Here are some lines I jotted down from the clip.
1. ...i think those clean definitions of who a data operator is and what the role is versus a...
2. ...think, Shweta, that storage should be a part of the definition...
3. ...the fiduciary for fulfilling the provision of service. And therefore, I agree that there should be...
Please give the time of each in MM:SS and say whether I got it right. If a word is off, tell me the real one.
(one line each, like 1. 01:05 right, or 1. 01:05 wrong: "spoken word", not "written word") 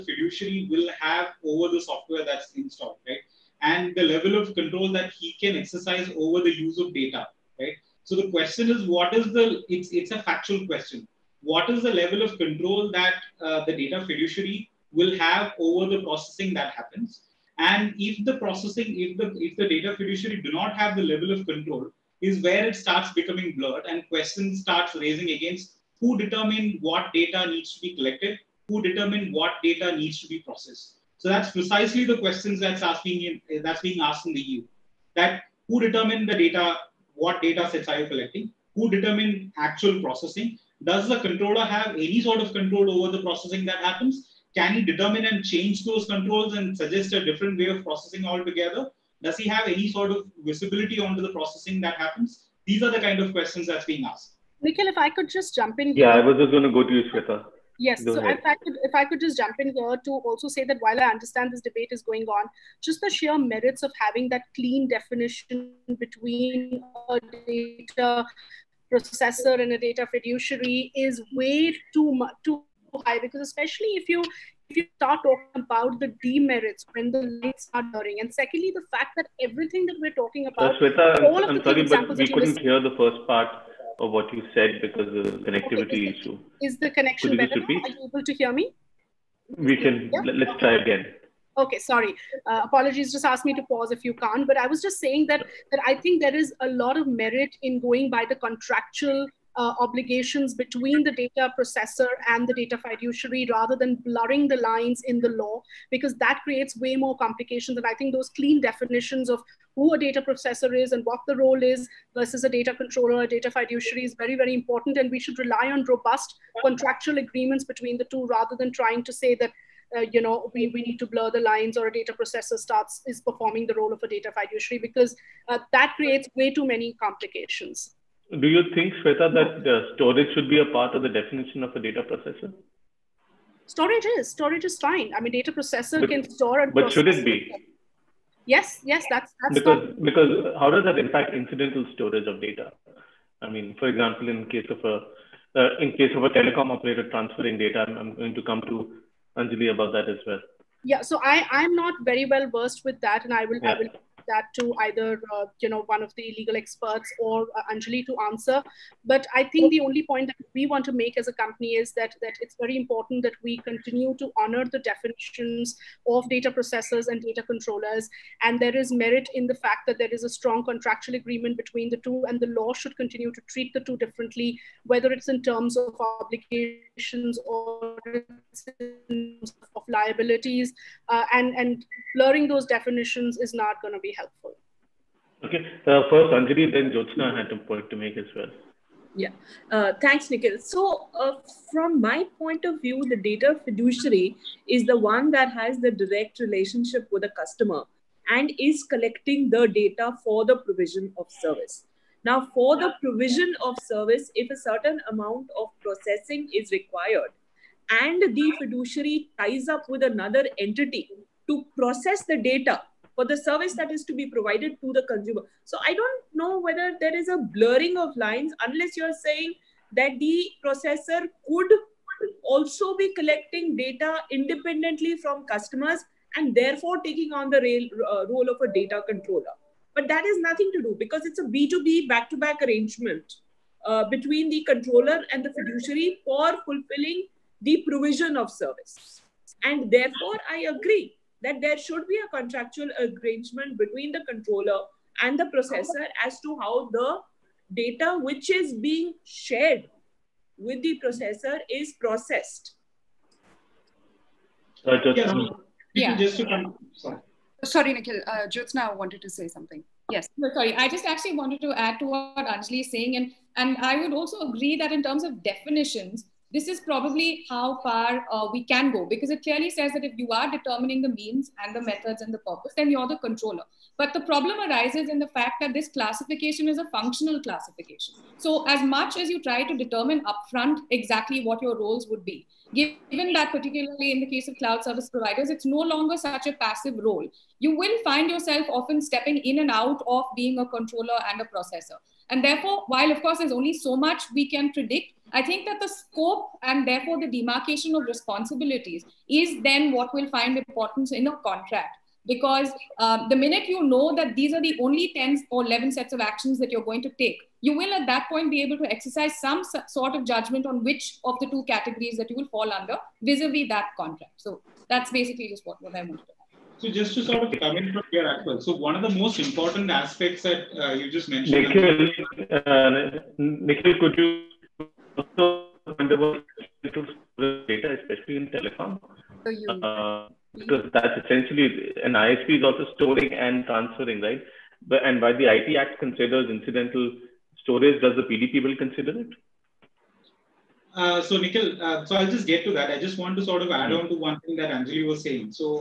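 1. 01:47 wrong: "processor", not "operator"
2. 02:08 right
3. 03:55 right.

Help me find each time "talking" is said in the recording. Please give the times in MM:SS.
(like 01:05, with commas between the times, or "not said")
01:15, 01:20.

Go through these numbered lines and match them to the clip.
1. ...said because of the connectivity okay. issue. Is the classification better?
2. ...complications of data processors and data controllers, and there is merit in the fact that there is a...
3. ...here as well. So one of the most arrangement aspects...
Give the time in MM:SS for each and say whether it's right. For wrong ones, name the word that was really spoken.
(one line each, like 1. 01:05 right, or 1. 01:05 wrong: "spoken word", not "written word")
1. 01:24 wrong: "connection", not "classification"
2. 02:44 wrong: "definitions", not "complications"
3. 05:18 wrong: "important", not "arrangement".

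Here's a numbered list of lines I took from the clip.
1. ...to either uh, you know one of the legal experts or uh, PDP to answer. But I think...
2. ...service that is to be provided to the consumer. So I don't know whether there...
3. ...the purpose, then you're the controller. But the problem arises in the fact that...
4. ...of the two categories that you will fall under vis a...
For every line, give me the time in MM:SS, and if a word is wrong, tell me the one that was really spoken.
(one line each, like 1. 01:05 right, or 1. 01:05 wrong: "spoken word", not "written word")
1. 02:34 wrong: "Anjali", not "PDP"
2. 03:33 right
3. 04:32 right
4. 05:11 right.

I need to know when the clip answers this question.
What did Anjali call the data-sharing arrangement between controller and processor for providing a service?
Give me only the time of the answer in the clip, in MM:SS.
03:51.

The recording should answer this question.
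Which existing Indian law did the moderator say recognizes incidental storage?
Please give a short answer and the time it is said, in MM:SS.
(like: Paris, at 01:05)
IT Act, at 05:35.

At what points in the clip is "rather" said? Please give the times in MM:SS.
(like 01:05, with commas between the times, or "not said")
01:43, 01:58.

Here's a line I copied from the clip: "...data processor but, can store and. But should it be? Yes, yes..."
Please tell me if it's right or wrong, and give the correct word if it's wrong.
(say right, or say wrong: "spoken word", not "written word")
right.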